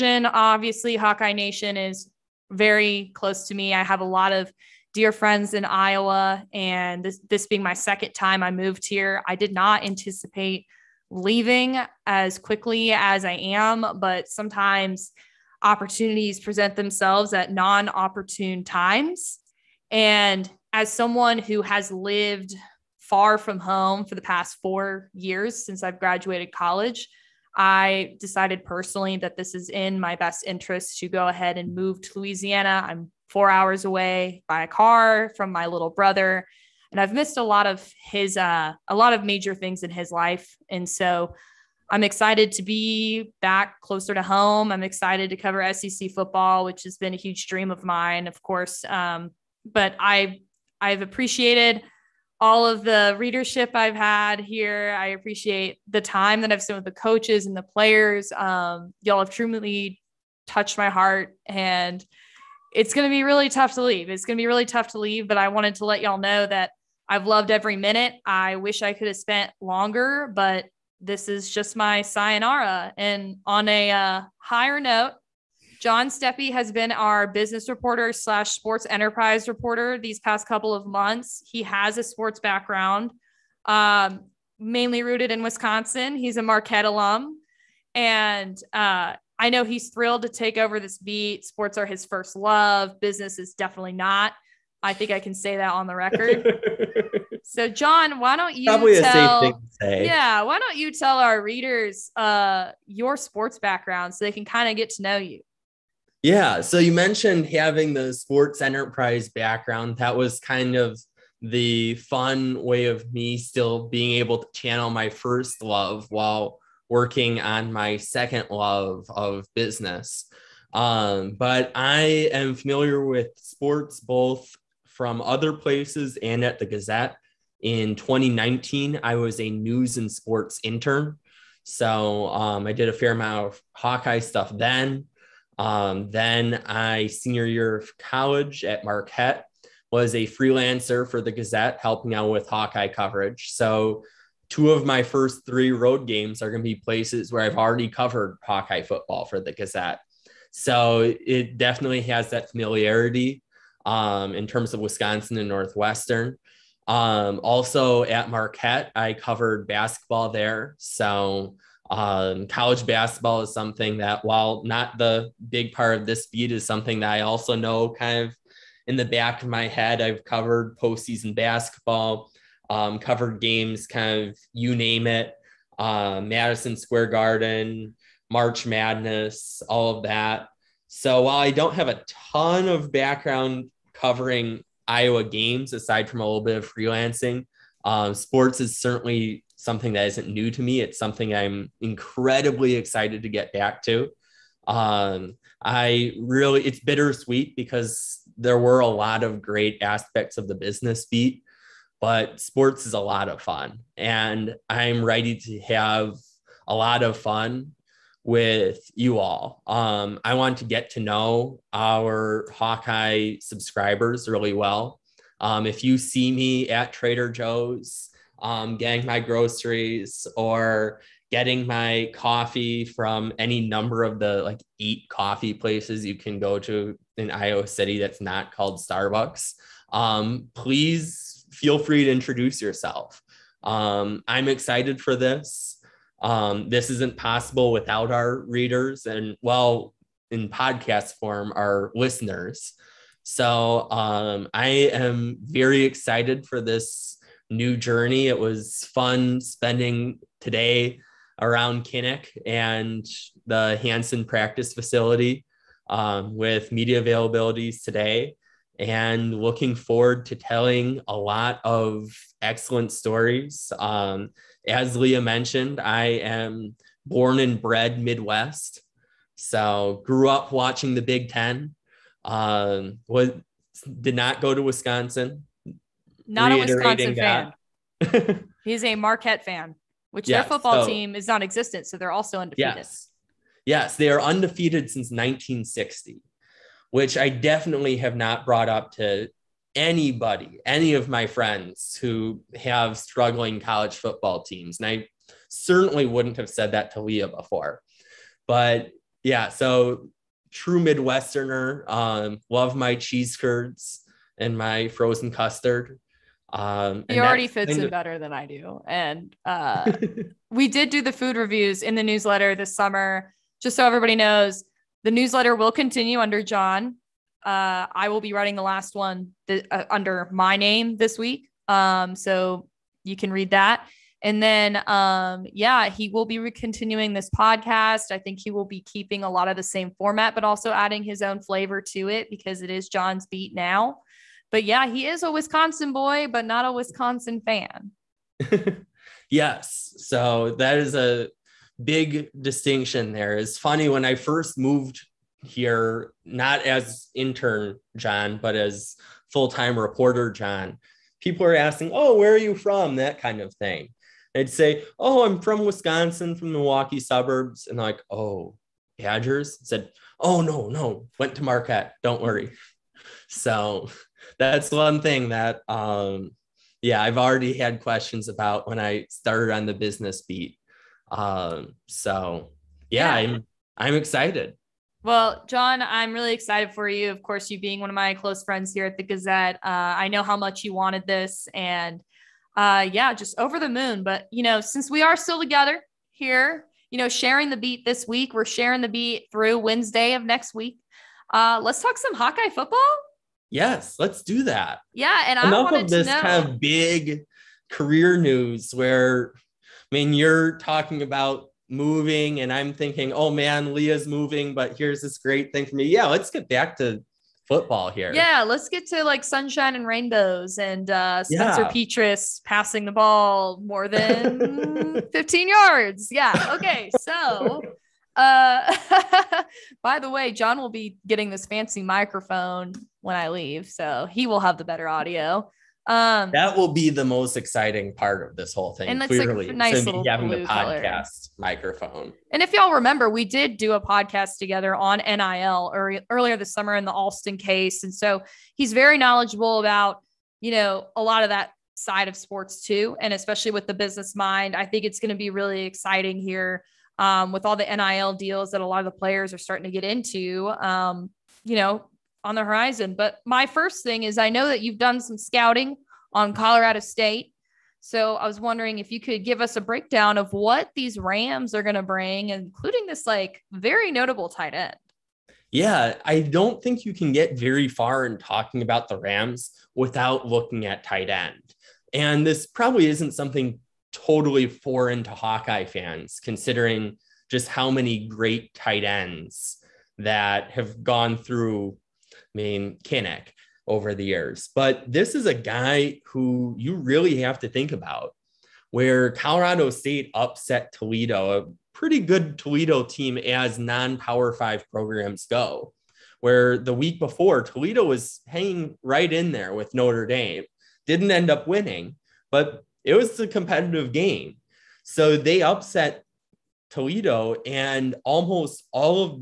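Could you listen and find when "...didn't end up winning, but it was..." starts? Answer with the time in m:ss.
8:20.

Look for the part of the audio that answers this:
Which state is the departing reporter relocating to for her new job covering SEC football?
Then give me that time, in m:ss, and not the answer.
0:32.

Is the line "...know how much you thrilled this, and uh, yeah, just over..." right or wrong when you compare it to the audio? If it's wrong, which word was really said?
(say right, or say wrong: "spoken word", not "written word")
wrong: "wanted", not "thrilled".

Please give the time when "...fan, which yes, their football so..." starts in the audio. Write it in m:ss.
4:39.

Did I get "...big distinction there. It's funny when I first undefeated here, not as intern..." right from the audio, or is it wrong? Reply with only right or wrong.
wrong.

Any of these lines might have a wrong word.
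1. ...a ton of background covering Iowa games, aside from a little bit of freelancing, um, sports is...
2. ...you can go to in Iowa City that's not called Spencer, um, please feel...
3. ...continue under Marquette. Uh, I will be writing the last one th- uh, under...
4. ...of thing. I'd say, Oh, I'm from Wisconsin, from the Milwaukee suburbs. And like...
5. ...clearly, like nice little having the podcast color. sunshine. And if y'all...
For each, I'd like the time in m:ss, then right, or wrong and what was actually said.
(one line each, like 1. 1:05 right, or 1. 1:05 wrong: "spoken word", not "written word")
1. 3:01 right
2. 3:46 wrong: "Starbucks", not "Spencer"
3. 5:15 wrong: "John", not "Marquette"
4. 5:53 right
5. 7:09 wrong: "microphone", not "sunshine".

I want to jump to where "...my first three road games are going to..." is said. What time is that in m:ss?
2:24.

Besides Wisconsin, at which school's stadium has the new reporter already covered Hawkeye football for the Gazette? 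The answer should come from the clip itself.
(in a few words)
Northwestern.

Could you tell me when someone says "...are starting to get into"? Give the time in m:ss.
7:29.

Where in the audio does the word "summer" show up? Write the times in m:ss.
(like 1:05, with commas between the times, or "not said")
5:12, 7:16.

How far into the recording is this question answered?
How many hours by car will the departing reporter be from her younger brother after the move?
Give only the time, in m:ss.
0:33.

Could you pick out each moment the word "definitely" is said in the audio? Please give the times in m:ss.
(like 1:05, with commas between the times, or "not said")
1:33, 2:31, 4:47.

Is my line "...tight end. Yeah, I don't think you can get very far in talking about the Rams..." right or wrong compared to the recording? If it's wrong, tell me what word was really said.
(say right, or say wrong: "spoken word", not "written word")
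right.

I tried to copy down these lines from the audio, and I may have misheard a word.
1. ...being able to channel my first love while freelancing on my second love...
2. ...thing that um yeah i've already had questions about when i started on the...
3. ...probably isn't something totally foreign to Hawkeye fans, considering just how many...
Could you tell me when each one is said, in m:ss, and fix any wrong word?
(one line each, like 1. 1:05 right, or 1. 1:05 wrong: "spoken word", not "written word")
1. 1:53 wrong: "working", not "freelancing"
2. 6:05 right
3. 7:52 right.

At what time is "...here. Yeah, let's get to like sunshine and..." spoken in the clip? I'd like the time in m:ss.
6:47.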